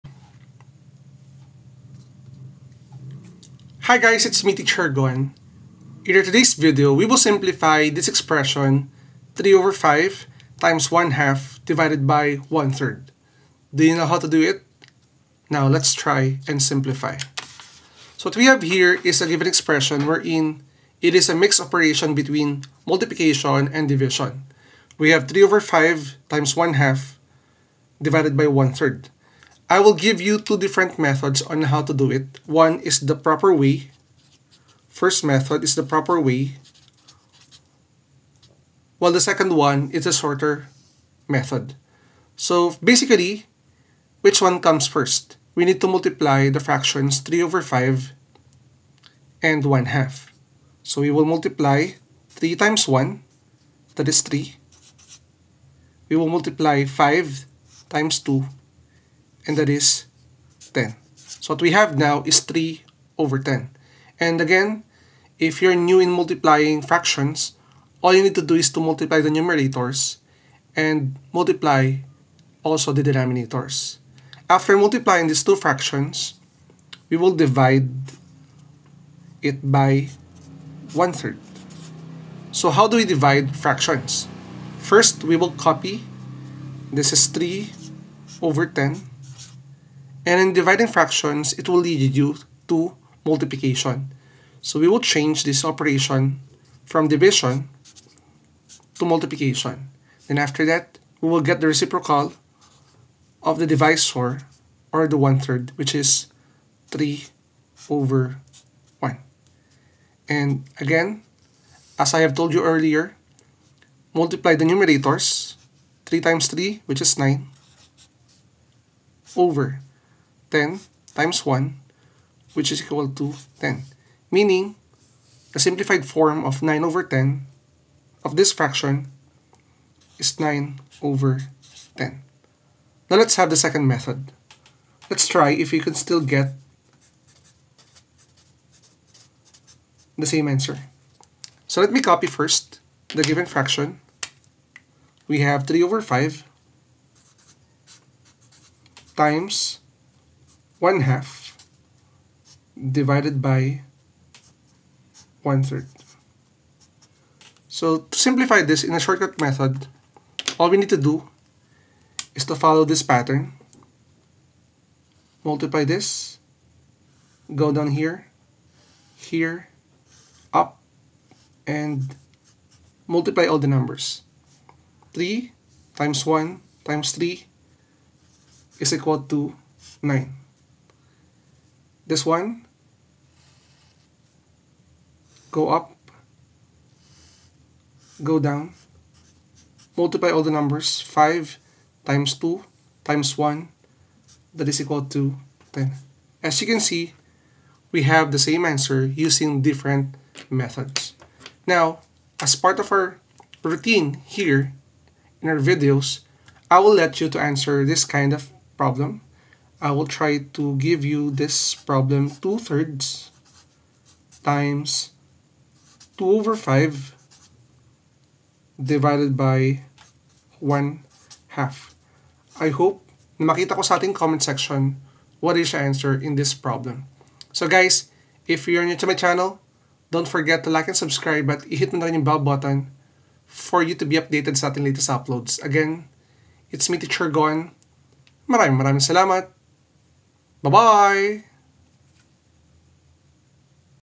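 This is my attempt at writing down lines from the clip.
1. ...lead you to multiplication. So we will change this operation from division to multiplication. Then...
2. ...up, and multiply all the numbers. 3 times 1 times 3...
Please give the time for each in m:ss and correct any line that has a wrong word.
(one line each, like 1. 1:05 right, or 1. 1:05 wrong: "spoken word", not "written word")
1. 1:31 right
2. 2:50 right.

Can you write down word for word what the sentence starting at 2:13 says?
Now let's have the second method.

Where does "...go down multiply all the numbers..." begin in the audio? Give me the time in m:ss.
3:08.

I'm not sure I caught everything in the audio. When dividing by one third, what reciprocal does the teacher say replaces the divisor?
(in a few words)
3/1.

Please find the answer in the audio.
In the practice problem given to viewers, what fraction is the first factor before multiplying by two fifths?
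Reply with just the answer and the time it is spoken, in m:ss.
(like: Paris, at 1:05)
2/3, at 3:32.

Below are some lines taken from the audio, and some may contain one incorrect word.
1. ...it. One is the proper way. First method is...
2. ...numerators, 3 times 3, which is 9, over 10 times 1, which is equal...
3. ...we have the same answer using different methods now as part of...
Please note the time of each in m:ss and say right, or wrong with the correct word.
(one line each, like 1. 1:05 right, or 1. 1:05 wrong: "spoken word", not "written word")
1. 0:32 right
2. 1:54 right
3. 3:17 right.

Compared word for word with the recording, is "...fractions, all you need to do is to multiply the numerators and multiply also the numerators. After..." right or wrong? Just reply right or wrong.
wrong.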